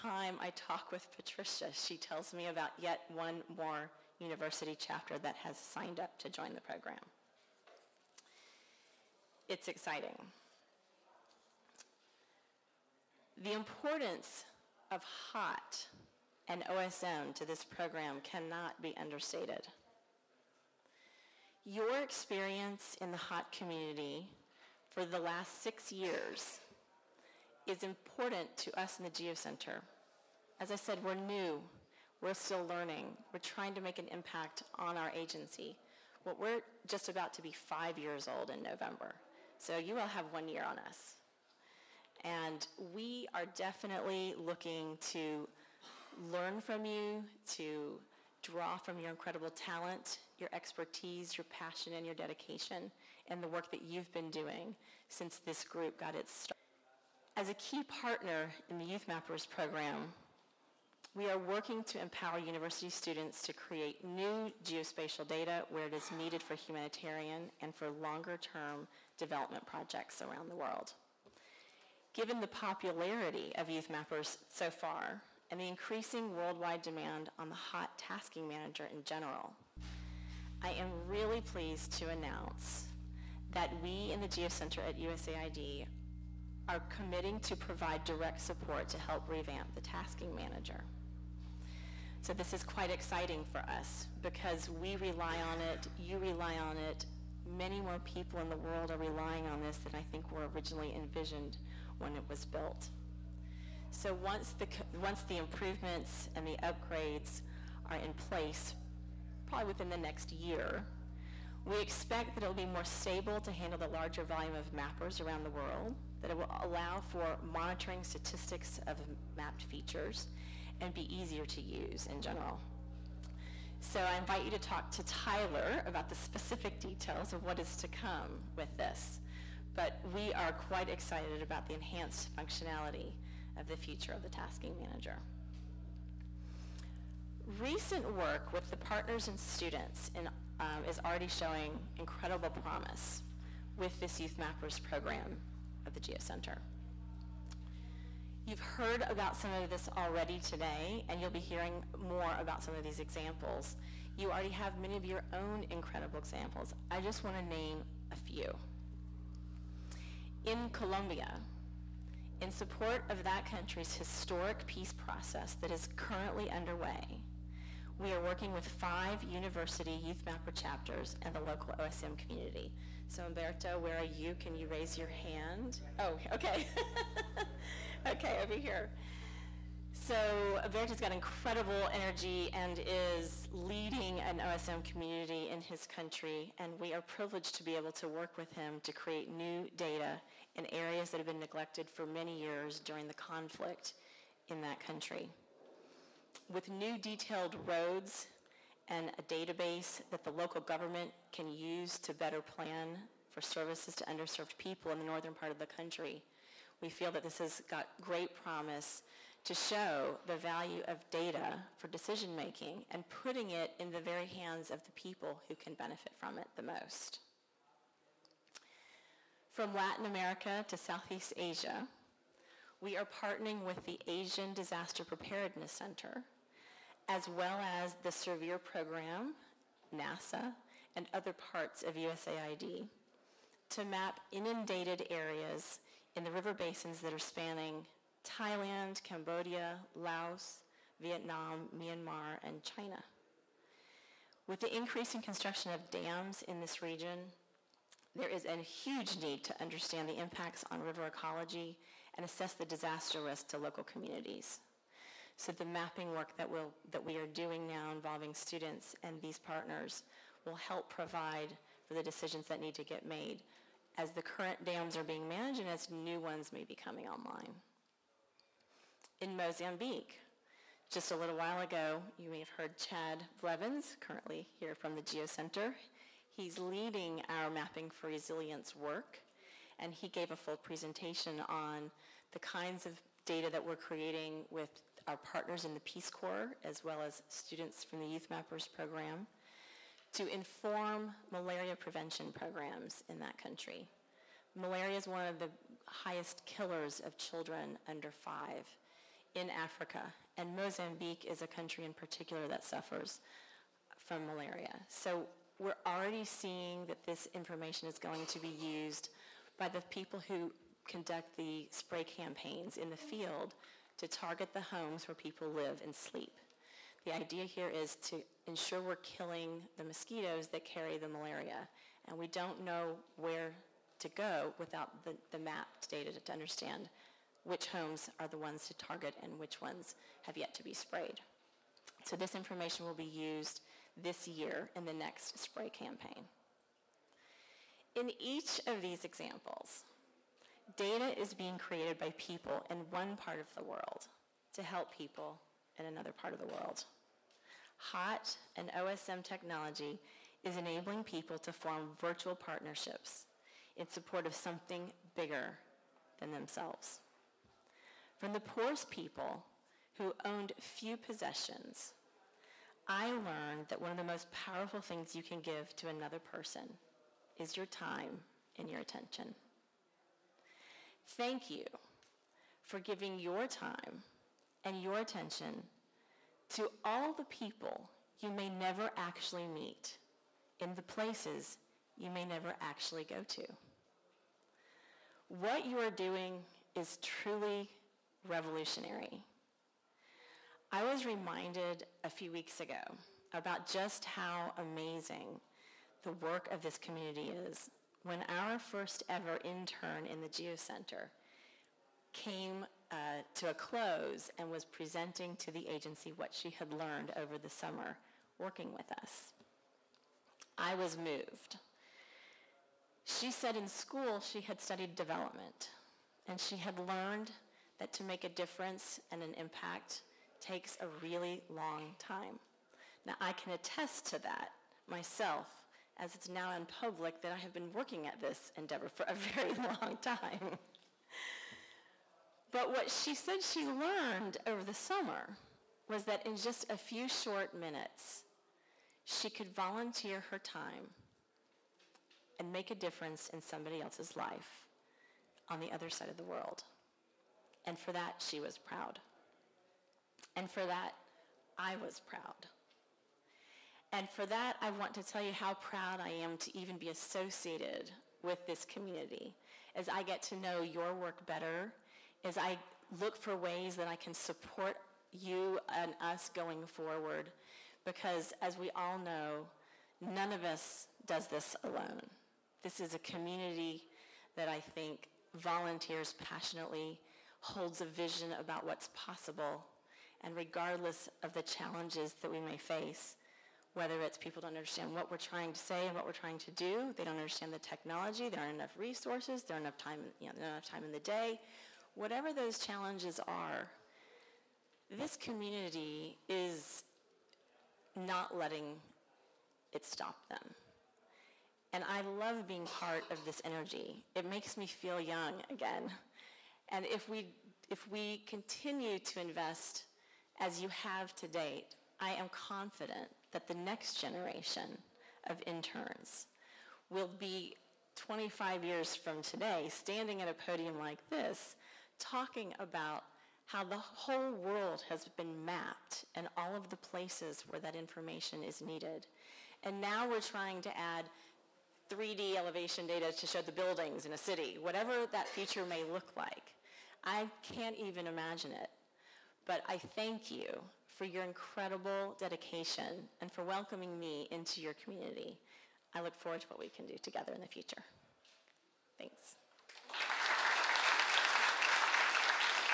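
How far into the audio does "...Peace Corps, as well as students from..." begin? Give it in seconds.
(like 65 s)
285 s.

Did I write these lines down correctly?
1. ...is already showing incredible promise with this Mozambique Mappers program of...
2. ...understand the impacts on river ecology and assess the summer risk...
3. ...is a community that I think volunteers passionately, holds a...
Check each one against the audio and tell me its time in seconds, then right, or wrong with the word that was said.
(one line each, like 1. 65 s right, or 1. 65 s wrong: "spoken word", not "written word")
1. 140 s wrong: "Youth", not "Mozambique"
2. 249 s wrong: "disaster", not "summer"
3. 472 s right.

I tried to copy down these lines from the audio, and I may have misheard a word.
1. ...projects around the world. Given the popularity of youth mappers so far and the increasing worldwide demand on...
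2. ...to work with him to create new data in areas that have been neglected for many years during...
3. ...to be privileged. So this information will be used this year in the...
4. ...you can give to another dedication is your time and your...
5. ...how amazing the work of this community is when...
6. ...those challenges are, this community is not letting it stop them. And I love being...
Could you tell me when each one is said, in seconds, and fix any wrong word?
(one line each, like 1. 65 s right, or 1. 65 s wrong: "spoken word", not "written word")
1. 69 s right
2. 187 s right
3. 330 s wrong: "sprayed", not "privileged"
4. 365 s wrong: "person", not "dedication"
5. 394 s right
6. 492 s right.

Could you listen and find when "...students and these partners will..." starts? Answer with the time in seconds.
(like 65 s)
258 s.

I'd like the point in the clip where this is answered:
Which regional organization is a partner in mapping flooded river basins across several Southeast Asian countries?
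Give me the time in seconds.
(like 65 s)
224 s.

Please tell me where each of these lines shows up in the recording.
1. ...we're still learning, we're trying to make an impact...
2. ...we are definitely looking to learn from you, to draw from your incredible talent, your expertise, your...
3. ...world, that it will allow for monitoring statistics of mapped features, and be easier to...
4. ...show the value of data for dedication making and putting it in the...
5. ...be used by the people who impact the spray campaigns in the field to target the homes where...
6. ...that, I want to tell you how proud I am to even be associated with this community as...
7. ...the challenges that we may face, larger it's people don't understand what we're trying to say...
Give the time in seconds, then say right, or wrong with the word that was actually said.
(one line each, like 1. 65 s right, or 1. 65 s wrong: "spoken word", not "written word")
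1. 32 s right
2. 42 s right
3. 115 s right
4. 209 s wrong: "decision", not "dedication"
5. 308 s wrong: "conduct", not "impact"
6. 454 s right
7. 481 s wrong: "whether", not "larger".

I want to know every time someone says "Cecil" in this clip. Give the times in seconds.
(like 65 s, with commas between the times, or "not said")
not said.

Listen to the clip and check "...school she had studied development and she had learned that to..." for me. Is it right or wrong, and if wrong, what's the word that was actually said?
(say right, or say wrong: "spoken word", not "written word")
right.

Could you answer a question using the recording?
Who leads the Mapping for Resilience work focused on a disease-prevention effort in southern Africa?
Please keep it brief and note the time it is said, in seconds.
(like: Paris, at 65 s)
Chad Blevins, at 272 s.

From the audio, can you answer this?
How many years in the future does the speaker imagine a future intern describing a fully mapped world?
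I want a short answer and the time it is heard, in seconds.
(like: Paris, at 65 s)
25, at 517 s.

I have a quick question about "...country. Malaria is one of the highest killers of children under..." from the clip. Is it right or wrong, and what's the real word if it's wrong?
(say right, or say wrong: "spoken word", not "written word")
right.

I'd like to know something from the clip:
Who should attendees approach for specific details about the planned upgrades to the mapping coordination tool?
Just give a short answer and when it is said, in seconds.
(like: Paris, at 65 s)
Tyler, at 125 s.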